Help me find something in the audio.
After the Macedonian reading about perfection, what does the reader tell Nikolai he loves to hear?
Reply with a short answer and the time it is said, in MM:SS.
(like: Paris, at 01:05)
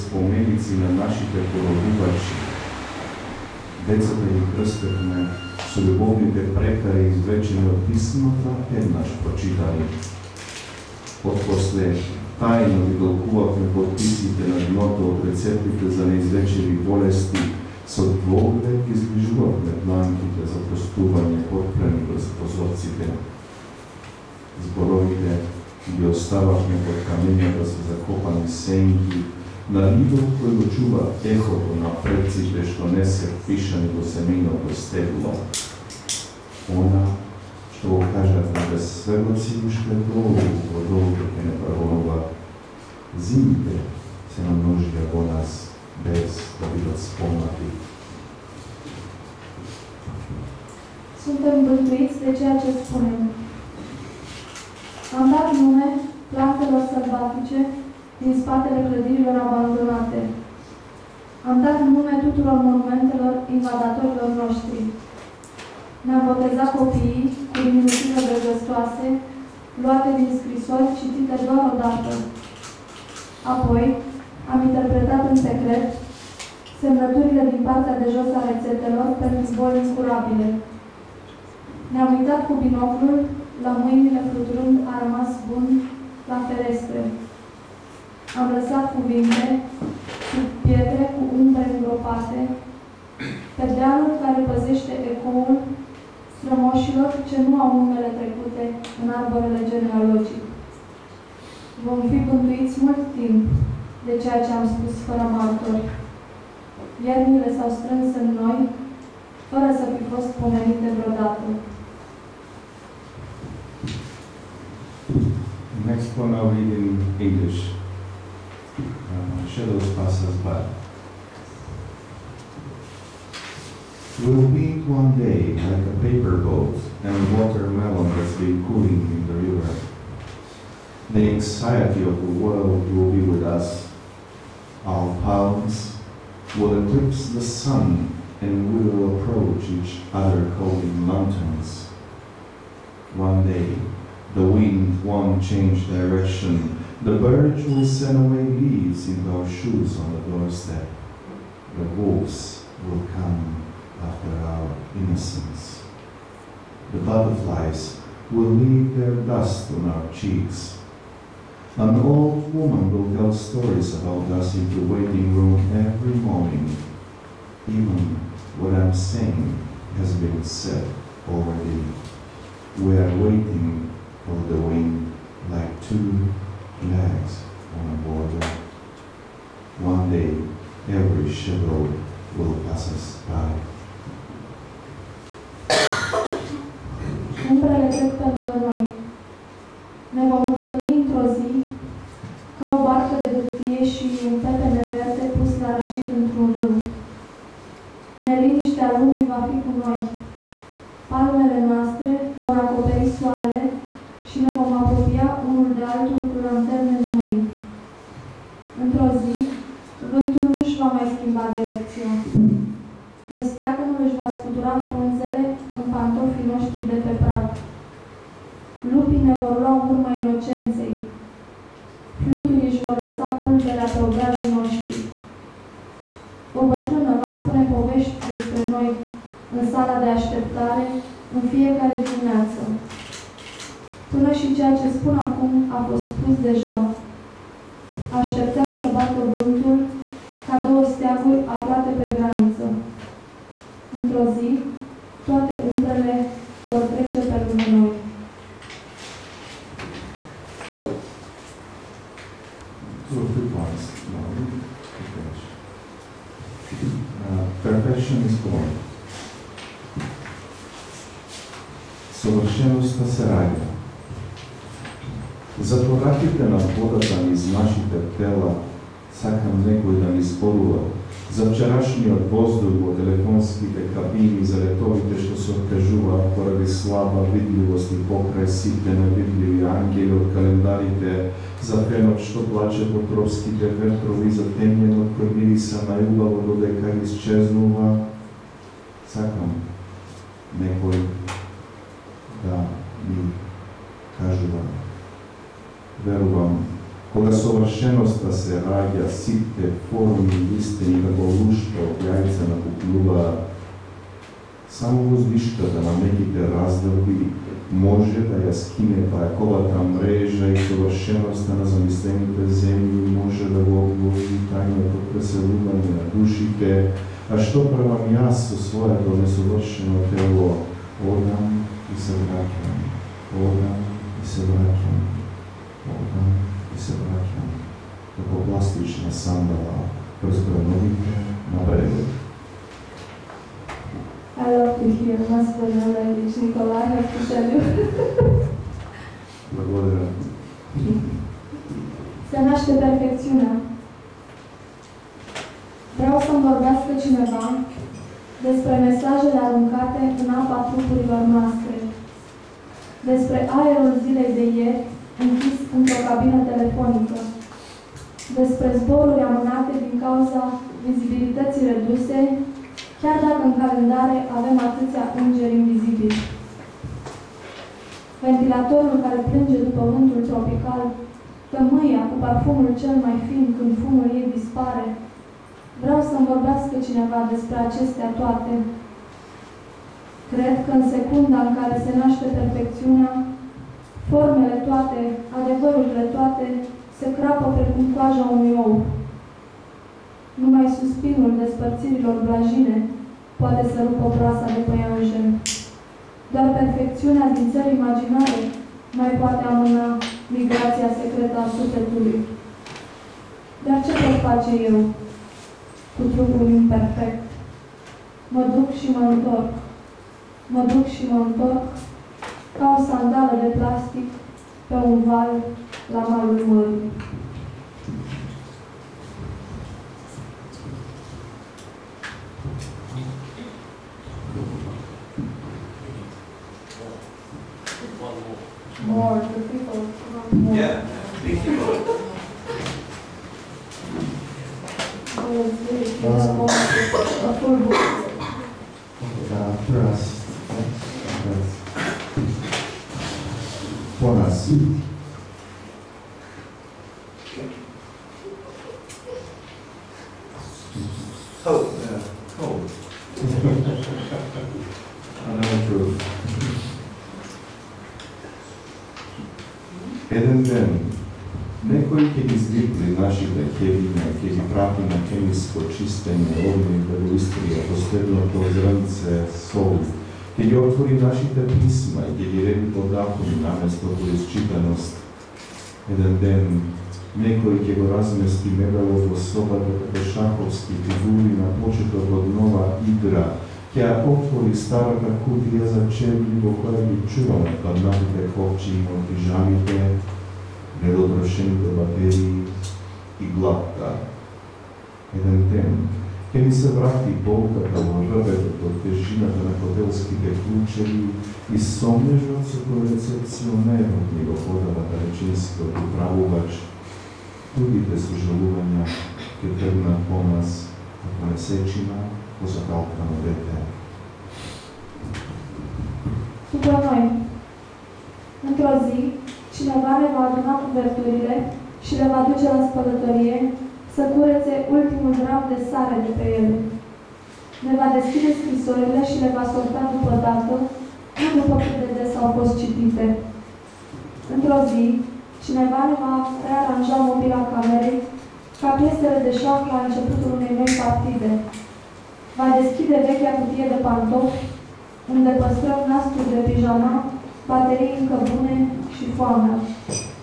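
my Spanish language, at 05:35.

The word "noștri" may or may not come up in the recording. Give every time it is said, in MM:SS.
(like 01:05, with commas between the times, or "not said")
01:04, 03:36, 03:44.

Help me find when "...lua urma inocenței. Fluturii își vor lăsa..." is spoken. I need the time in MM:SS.
03:39.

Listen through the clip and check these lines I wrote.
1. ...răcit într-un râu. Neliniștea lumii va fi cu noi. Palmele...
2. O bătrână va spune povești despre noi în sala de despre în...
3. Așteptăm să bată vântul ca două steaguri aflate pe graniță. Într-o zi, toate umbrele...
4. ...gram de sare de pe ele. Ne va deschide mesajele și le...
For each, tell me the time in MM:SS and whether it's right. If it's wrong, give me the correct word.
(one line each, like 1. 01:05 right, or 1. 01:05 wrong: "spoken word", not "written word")
1. 03:15 right
2. 03:46 wrong: "așteptare", not "despre"
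3. 03:58 right
4. 08:45 wrong: "scrisorile", not "mesajele".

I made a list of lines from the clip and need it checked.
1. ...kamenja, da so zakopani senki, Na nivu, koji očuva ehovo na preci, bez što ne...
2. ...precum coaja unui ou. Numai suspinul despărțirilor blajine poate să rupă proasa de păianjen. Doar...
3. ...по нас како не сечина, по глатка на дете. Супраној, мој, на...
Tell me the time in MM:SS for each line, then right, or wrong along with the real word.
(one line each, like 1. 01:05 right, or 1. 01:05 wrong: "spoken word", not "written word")
1. 00:27 right
2. 06:27 right
3. 08:30 wrong: "закалка", not "глатка".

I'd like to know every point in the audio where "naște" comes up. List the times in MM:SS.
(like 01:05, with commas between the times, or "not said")
05:42, 06:22.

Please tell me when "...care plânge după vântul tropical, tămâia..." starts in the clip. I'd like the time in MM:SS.
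06:09.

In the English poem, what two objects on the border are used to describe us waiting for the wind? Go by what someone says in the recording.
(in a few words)
two flags.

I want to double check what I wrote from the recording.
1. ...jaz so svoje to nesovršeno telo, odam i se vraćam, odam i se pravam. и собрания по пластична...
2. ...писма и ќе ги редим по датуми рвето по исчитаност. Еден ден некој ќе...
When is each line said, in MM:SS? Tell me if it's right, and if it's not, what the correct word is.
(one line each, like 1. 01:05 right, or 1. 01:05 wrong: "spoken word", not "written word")
1. 05:18 wrong: "vraćam", not "pravam"
2. 07:51 wrong: "наместо", not "рвето".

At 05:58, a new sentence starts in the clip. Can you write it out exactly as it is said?
Despre zboruri amânate din cauza vizibilității reduse, chiar dacă în calendare avem atâția îngeri invizibili.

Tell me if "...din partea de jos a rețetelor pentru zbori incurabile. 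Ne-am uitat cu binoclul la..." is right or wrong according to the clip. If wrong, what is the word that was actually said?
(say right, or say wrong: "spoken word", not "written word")
right.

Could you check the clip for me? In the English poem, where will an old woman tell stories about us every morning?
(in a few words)
the waiting room.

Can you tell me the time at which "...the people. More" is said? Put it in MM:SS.
07:09.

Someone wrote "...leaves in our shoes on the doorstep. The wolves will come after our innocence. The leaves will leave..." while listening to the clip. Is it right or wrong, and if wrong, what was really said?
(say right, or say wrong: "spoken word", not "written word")
wrong: "butterflies", not "leaves".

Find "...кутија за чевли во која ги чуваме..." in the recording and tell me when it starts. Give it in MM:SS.
08:05.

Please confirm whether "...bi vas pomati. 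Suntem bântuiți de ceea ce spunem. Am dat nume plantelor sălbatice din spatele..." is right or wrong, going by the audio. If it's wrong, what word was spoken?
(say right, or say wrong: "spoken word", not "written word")
right.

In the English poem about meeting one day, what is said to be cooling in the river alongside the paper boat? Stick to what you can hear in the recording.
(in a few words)
watermelon.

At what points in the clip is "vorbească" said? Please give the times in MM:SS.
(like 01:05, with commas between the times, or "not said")
05:46, 06:16.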